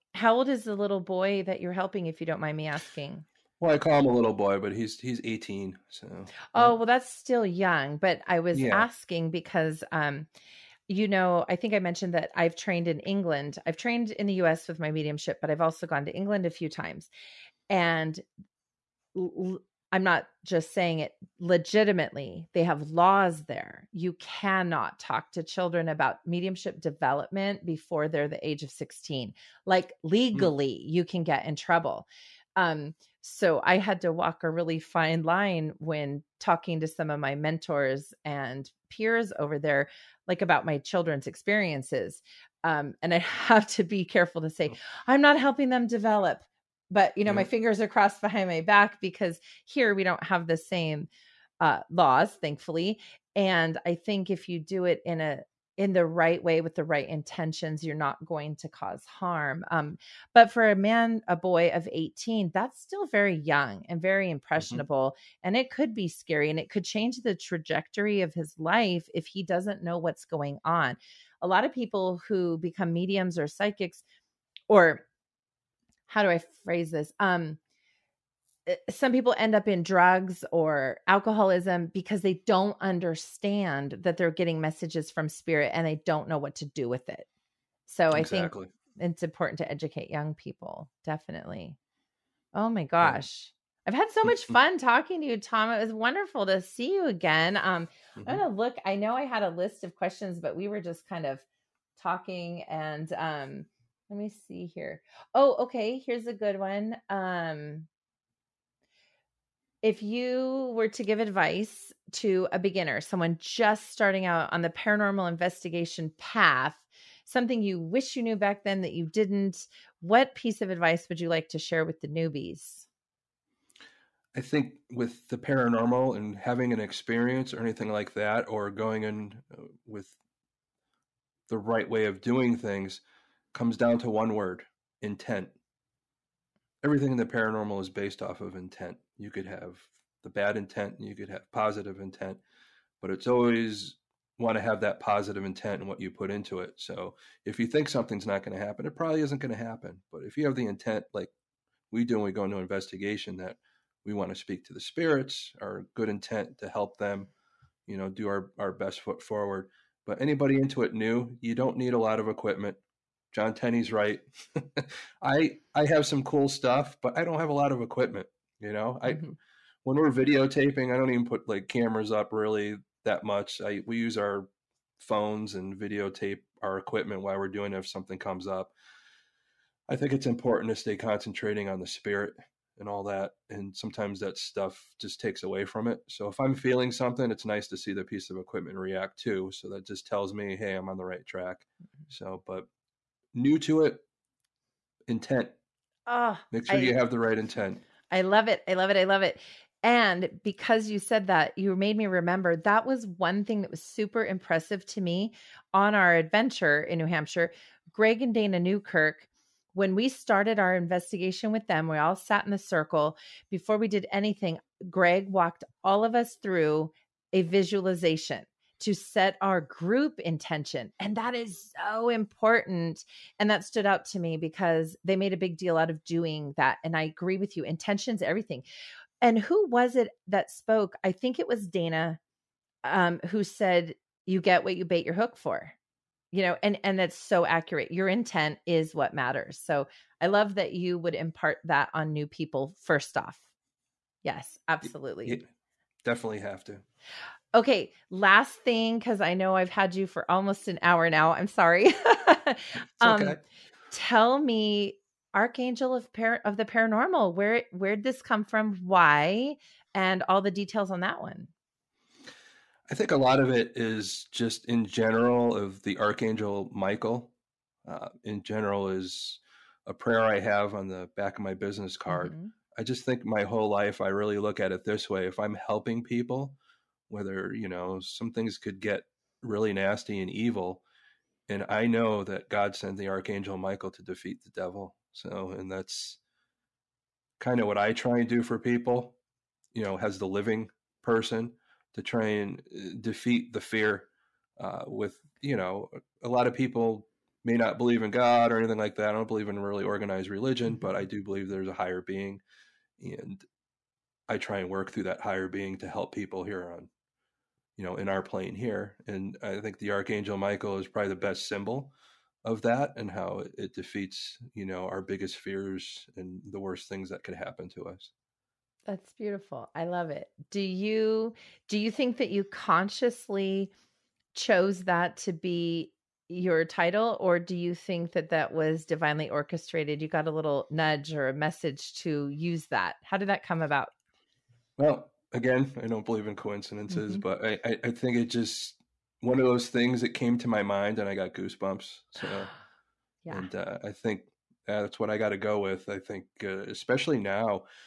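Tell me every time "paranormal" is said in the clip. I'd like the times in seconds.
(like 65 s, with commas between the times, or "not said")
114 s, 125 s, 137 s, 256 s.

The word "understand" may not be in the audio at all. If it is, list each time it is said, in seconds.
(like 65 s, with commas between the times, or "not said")
82 s.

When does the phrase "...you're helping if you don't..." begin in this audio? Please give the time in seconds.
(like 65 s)
1 s.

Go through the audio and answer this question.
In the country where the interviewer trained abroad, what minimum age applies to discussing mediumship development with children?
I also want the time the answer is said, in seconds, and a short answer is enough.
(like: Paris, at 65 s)
16, at 28 s.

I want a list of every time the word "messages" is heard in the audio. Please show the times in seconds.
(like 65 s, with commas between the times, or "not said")
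84 s, 331 s.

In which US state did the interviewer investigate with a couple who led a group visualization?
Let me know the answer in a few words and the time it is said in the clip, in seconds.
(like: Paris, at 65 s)
New Hampshire, at 206 s.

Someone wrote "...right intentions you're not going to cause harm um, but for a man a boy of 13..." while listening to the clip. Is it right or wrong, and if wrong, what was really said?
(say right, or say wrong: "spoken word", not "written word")
wrong: "18", not "13".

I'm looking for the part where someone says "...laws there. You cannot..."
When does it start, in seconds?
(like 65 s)
22 s.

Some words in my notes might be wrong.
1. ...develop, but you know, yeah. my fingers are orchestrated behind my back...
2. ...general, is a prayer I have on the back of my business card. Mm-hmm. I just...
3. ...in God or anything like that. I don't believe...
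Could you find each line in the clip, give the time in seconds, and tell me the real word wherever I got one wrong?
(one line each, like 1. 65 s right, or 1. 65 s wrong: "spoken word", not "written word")
1. 45 s wrong: "crossed", not "orchestrated"
2. 268 s right
3. 298 s right.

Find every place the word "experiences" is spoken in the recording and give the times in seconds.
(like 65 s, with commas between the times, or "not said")
41 s, 126 s.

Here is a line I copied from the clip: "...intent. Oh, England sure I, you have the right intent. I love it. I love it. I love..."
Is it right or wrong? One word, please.
wrong.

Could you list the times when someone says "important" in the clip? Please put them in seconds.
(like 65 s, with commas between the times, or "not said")
89 s, 180 s, 222 s.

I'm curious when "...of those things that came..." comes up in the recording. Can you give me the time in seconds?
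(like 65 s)
339 s.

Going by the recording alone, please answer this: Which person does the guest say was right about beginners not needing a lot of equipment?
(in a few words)
John Tenney.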